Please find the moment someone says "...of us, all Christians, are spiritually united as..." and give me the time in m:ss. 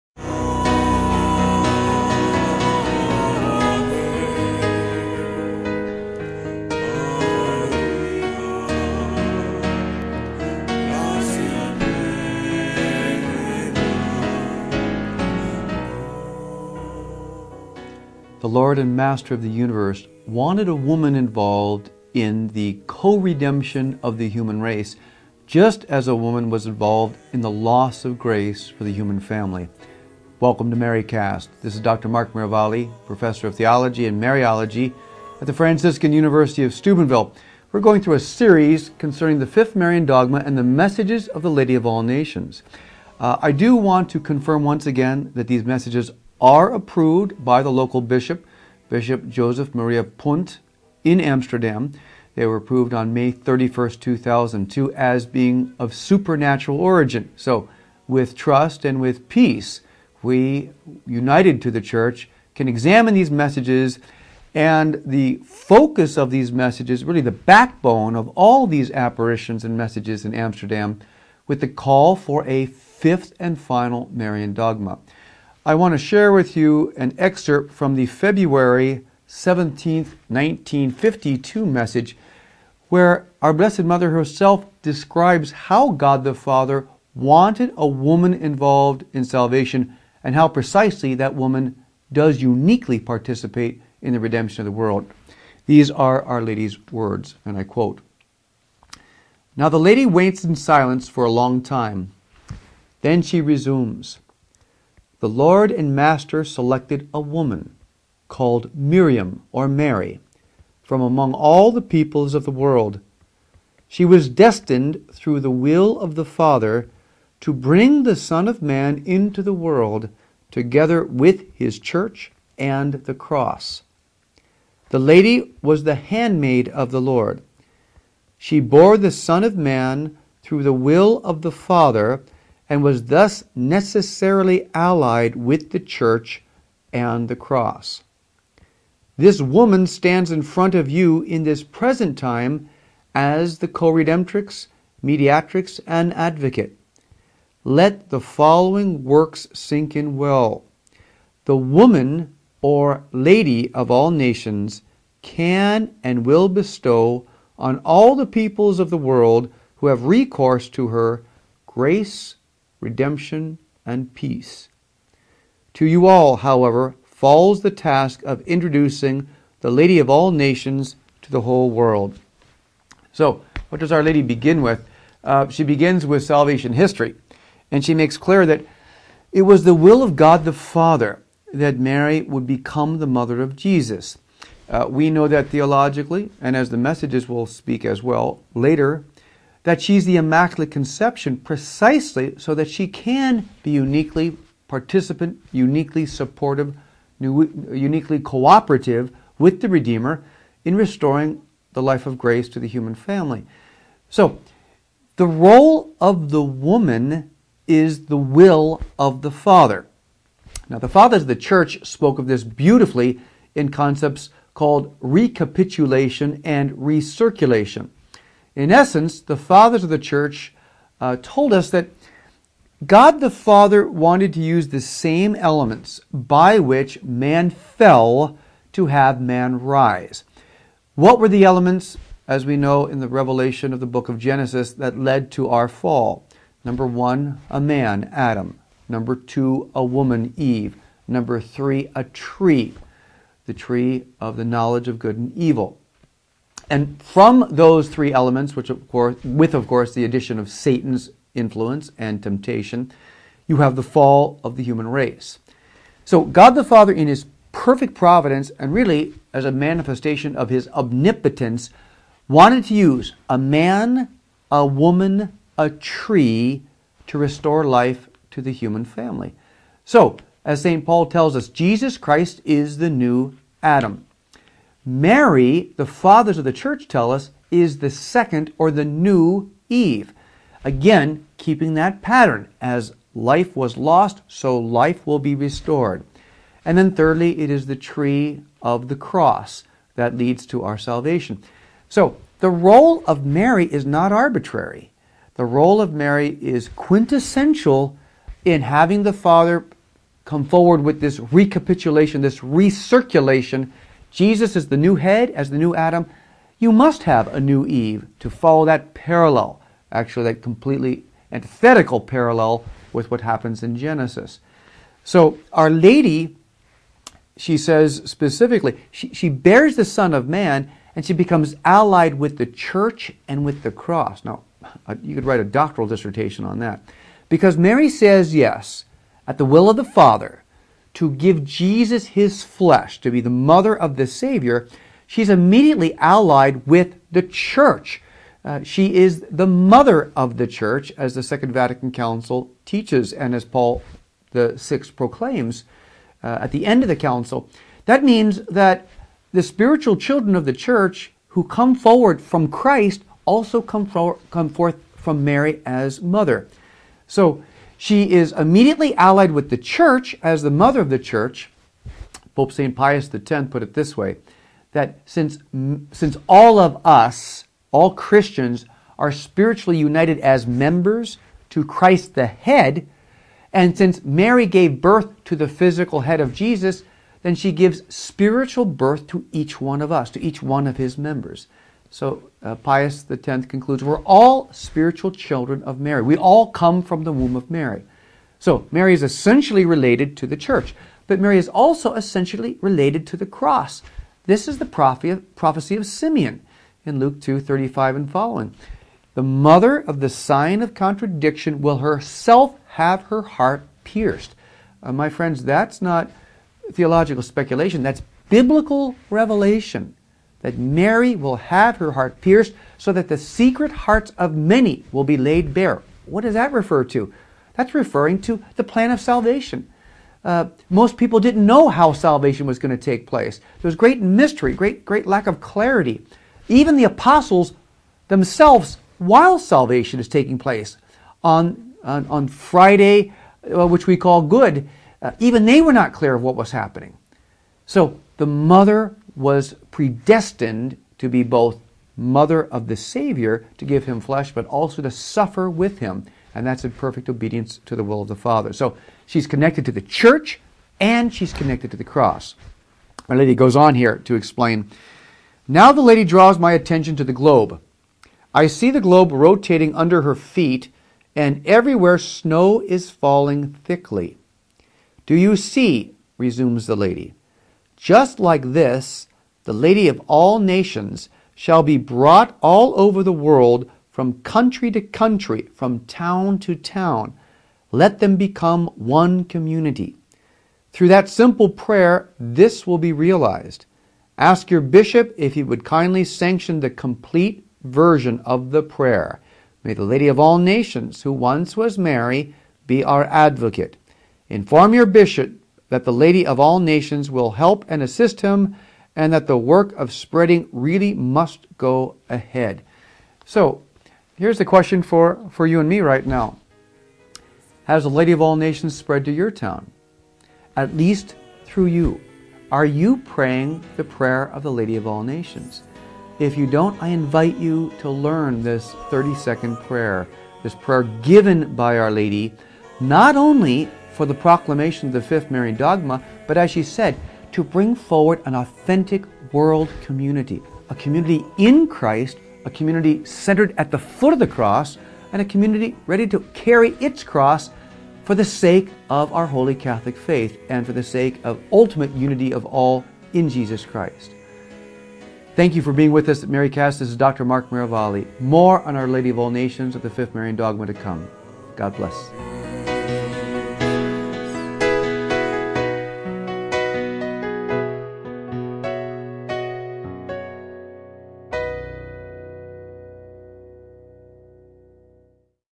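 6:06.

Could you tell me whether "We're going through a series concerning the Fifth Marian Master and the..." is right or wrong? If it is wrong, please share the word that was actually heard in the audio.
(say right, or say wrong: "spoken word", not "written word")
wrong: "Dogma", not "Master".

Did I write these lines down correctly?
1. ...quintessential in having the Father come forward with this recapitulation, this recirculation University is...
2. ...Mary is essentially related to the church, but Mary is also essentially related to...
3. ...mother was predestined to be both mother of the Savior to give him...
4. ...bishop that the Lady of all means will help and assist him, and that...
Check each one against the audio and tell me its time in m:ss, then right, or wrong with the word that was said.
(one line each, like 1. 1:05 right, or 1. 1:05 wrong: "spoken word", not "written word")
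1. 4:56 wrong: "Jesus", not "University"
2. 6:28 right
3. 7:18 right
4. 8:14 wrong: "nations", not "means".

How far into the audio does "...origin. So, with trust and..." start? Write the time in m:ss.
0:56.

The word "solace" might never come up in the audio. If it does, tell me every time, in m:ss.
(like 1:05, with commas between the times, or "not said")
not said.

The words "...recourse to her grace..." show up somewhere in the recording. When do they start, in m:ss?
2:40.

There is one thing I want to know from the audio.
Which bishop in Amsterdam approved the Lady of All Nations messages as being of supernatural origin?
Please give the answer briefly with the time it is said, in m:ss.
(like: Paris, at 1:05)
Joseph Maria Punt, at 0:48.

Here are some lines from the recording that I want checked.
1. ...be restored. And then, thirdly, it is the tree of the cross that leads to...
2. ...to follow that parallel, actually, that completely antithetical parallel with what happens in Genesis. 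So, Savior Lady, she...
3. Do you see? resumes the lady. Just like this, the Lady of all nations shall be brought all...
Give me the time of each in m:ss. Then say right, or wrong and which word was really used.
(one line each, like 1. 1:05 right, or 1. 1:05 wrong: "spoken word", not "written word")
1. 4:45 right
2. 5:08 wrong: "Our", not "Savior"
3. 7:45 right.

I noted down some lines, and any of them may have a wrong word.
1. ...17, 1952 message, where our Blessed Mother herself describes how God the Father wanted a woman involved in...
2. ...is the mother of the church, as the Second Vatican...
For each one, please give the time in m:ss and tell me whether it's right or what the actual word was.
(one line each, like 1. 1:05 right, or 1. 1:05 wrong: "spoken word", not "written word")
1. 1:19 right
2. 5:38 right.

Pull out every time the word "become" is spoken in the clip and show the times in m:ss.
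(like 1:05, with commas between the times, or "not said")
3:02, 5:21, 7:58.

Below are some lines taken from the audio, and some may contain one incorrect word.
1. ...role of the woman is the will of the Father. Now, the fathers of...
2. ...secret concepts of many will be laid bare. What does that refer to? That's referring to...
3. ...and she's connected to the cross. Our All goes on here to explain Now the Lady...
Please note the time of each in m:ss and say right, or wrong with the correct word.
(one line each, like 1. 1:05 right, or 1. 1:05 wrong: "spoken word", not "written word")
1. 3:25 right
2. 6:53 wrong: "hearts", not "concepts"
3. 7:30 wrong: "Lady", not "All".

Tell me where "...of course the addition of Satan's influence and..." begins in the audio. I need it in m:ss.
4:09.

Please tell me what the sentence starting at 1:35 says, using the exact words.
These are Our Lady's words, and I quote Now the lady waits in silence for a long time.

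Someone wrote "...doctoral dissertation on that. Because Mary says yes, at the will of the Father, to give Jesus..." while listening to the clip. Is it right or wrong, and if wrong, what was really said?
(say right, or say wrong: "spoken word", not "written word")
right.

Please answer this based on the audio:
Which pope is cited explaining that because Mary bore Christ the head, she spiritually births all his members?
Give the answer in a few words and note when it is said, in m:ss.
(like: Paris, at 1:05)
Pope St. Pius X, at 6:02.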